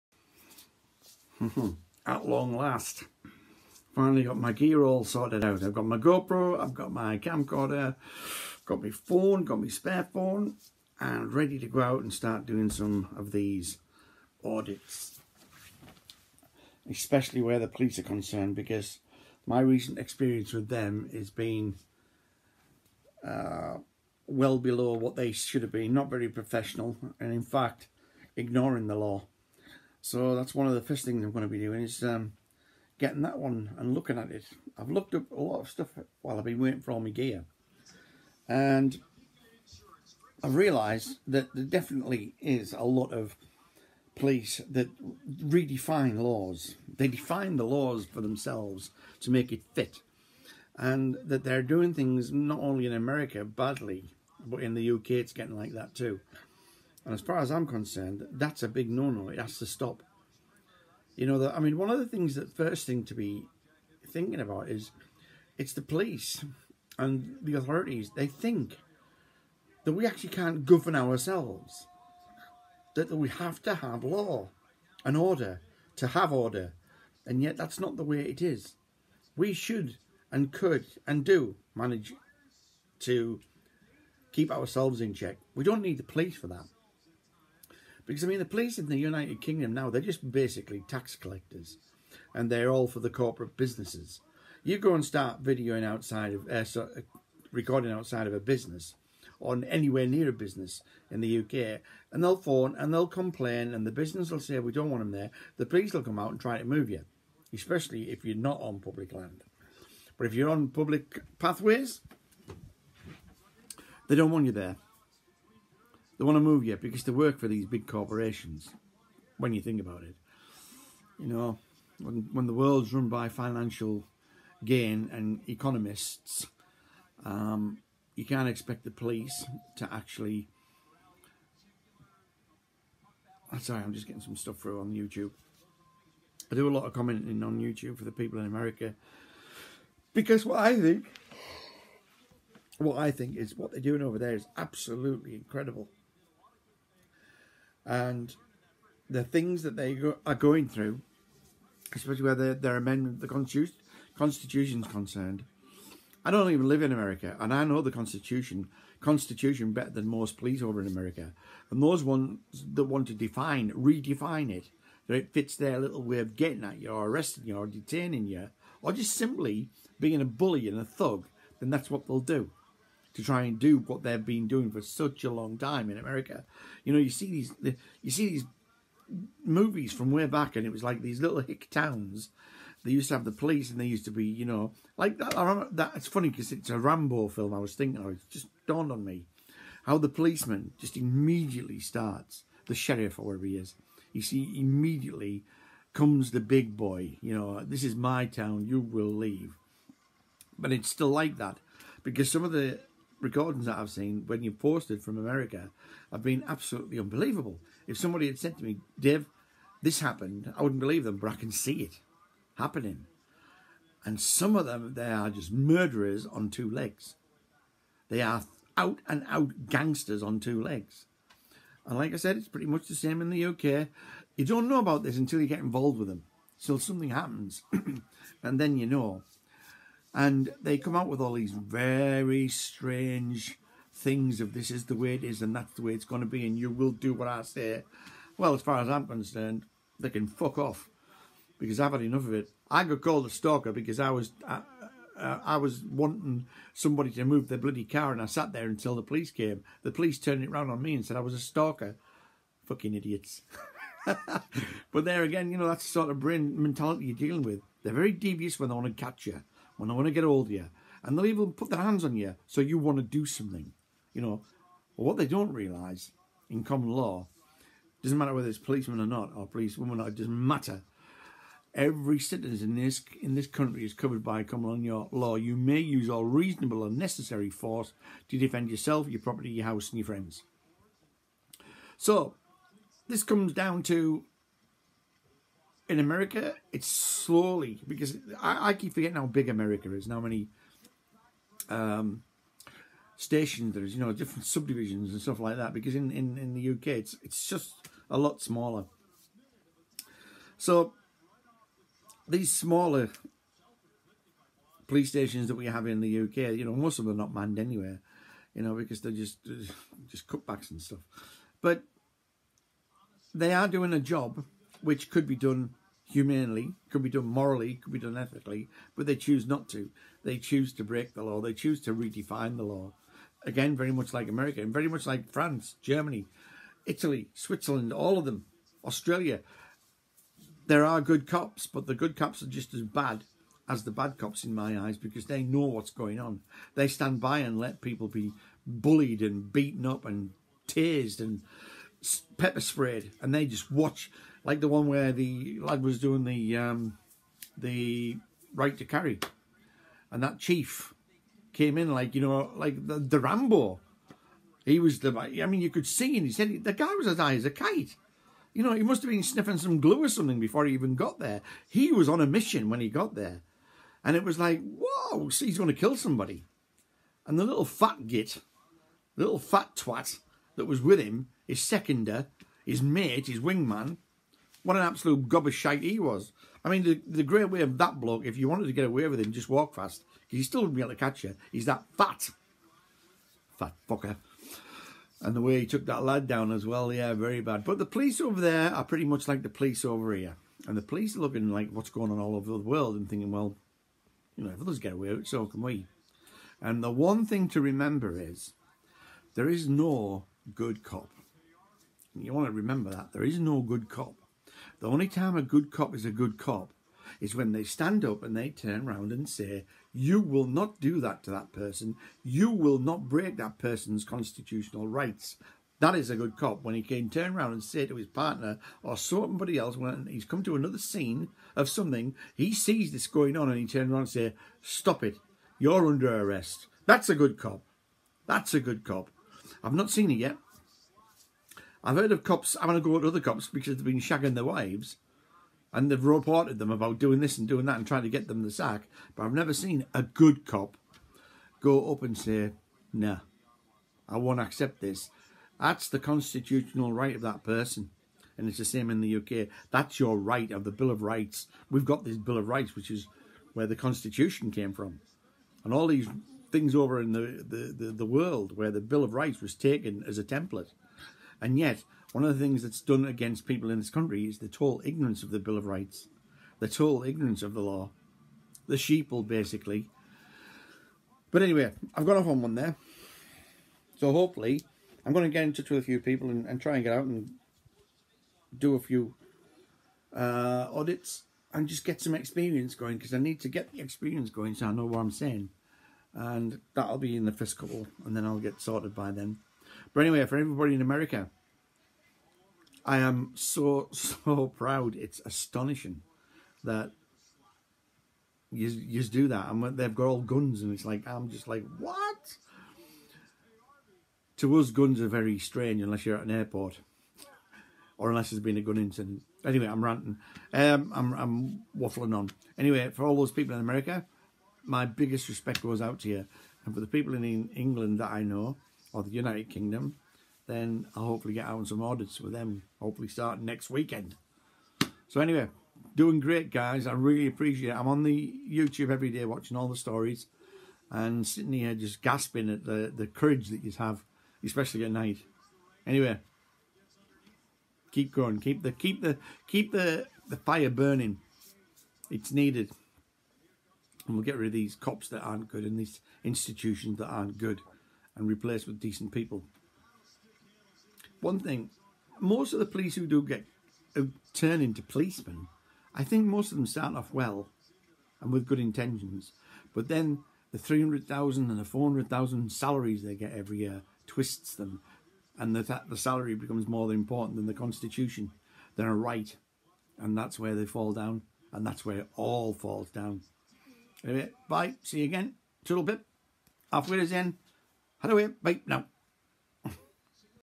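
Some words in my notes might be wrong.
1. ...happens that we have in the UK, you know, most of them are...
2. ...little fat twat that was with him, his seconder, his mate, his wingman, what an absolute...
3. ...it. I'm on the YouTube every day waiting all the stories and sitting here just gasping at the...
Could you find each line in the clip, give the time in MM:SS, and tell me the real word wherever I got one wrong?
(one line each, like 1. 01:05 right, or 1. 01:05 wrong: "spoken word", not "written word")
1. 05:05 wrong: "stations", not "happens"
2. 06:09 right
3. 08:47 wrong: "watching", not "waiting".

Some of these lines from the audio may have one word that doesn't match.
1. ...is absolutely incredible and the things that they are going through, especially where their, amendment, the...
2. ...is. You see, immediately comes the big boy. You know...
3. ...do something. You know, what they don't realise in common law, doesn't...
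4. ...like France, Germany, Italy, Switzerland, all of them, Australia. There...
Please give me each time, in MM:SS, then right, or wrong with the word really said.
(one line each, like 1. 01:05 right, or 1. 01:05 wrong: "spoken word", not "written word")
1. 02:24 right
2. 03:13 right
3. 04:23 right
4. 05:25 right.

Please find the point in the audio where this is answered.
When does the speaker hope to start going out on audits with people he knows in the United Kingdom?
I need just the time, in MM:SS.
08:43.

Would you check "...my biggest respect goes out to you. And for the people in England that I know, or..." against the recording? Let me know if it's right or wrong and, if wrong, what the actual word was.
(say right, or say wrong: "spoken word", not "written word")
right.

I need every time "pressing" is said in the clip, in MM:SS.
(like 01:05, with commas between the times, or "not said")
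not said.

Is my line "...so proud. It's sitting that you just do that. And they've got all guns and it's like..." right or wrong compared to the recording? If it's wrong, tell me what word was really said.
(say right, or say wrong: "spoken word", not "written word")
wrong: "astonishing", not "sitting".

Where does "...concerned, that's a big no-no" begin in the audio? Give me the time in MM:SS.
00:57.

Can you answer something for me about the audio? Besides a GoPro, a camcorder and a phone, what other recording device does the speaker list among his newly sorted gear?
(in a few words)
spare phone.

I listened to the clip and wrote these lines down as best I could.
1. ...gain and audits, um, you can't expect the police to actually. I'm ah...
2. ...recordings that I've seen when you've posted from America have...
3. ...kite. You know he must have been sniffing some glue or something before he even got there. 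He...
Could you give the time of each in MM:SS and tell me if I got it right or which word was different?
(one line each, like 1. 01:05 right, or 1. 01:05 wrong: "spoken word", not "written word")
1. 02:04 wrong: "economists", not "audits"
2. 03:23 right
3. 05:57 right.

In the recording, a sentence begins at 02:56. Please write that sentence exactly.
You know, you see these, you see these movies from way back, and it was like these little hick towns.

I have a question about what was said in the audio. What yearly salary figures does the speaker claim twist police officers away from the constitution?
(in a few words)
300,000 and 400,000.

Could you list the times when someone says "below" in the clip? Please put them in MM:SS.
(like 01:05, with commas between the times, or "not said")
00:24.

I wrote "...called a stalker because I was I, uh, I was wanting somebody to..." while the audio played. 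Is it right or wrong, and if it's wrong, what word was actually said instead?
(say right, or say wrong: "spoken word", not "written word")
right.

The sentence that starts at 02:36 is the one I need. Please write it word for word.
I don't even live in America, and I know the Constitution, Constitution better than most police over in America.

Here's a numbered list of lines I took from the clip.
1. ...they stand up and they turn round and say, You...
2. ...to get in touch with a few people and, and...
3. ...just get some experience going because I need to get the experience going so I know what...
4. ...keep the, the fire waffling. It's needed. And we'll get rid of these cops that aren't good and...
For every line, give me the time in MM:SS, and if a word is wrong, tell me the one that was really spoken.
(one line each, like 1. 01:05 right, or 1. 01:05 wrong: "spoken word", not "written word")
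1. 06:47 right
2. 07:55 right
3. 08:01 right
4. 08:59 wrong: "burning", not "waffling".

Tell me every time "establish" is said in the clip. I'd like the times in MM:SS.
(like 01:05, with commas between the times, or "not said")
not said.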